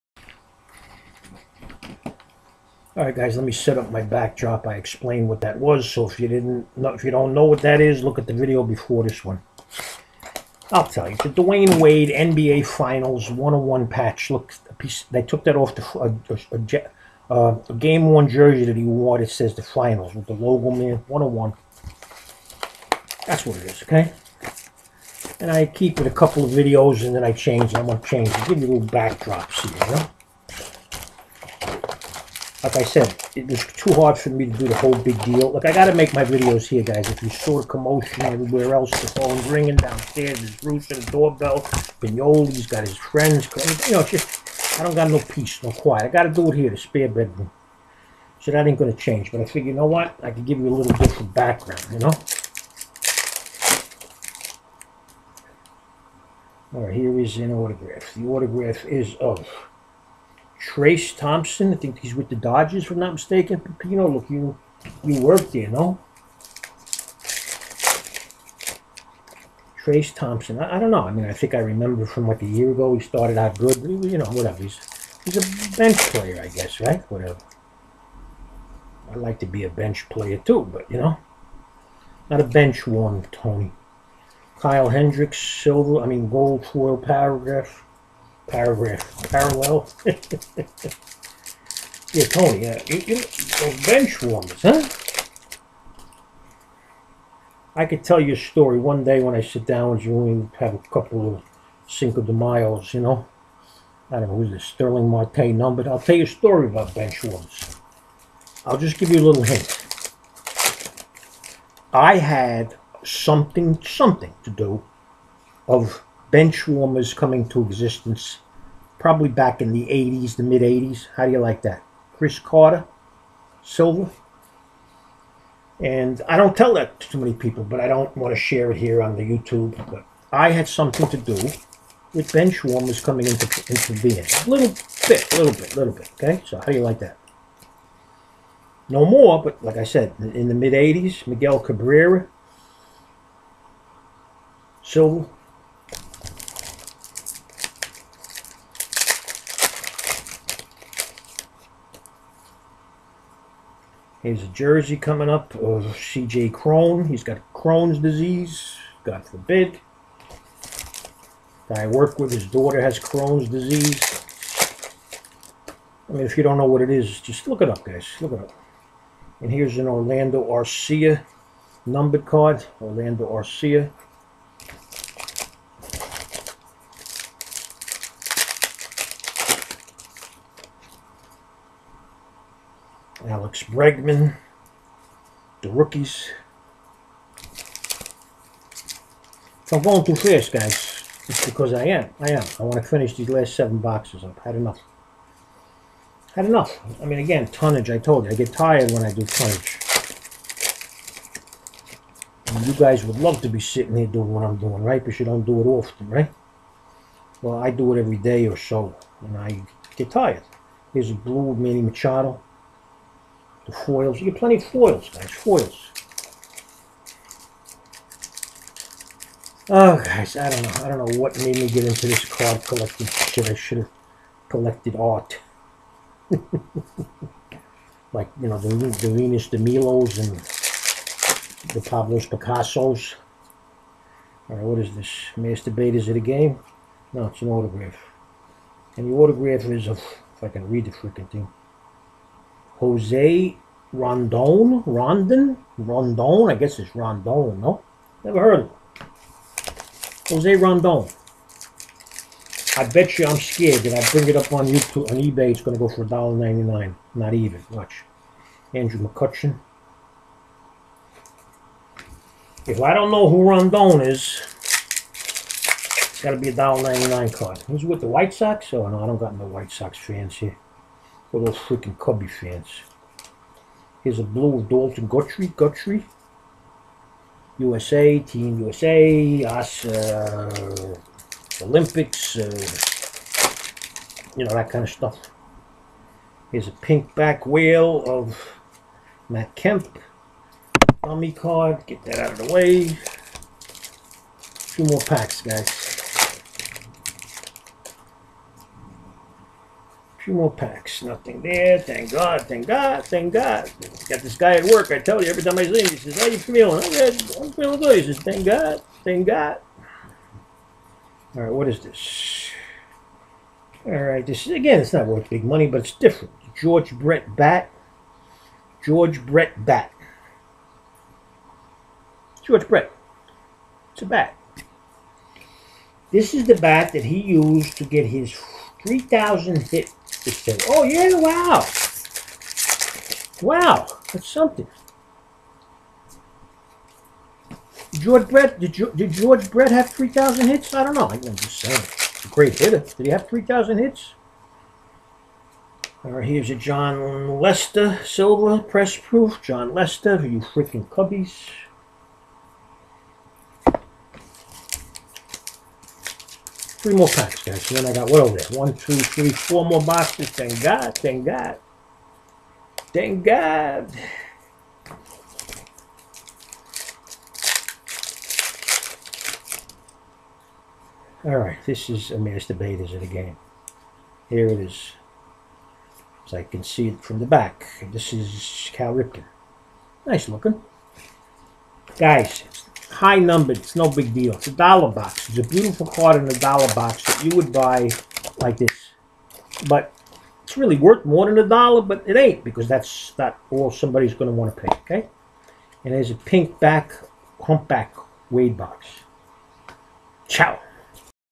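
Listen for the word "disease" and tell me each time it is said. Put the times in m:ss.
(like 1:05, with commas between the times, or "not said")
2:37, 2:43.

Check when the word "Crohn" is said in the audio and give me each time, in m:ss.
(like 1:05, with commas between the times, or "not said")
2:37, 2:42.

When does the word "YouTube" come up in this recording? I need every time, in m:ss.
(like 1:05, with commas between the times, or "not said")
2:09, 4:14.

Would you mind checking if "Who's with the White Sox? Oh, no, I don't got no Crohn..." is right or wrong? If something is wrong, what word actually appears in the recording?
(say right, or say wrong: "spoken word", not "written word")
wrong: "White", not "Crohn".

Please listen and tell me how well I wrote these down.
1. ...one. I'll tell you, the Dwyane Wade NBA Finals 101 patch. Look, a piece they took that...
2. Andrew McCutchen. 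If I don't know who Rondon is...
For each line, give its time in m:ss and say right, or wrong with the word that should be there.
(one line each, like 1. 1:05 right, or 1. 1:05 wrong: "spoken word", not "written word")
1. 0:09 right
2. 4:18 right.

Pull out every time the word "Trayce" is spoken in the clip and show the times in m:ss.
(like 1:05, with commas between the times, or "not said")
1:00, 1:09.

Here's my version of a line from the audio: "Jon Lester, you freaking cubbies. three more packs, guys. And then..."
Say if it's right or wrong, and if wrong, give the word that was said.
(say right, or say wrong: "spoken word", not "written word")
right.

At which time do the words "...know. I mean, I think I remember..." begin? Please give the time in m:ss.
1:10.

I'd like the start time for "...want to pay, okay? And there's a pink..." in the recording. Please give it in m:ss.
6:34.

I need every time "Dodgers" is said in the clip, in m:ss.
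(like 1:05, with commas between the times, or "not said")
1:02.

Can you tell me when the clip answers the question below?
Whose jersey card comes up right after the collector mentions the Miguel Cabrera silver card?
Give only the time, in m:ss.
2:35.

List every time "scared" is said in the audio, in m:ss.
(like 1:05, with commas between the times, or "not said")
4:13.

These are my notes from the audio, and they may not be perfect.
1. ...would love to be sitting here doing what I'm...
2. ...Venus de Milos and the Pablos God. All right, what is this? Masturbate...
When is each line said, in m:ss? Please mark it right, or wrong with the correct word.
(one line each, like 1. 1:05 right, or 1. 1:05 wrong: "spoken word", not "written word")
1. 3:23 right
2. 3:49 wrong: "Picassos", not "God".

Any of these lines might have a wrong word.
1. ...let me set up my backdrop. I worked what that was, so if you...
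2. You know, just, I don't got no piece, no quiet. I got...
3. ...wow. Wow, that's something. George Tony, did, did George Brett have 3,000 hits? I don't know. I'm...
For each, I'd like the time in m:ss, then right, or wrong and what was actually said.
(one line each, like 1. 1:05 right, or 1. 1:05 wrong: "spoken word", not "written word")
1. 0:03 wrong: "explained", not "worked"
2. 0:43 wrong: "peace", not "piece"
3. 5:31 wrong: "Brett", not "Tony".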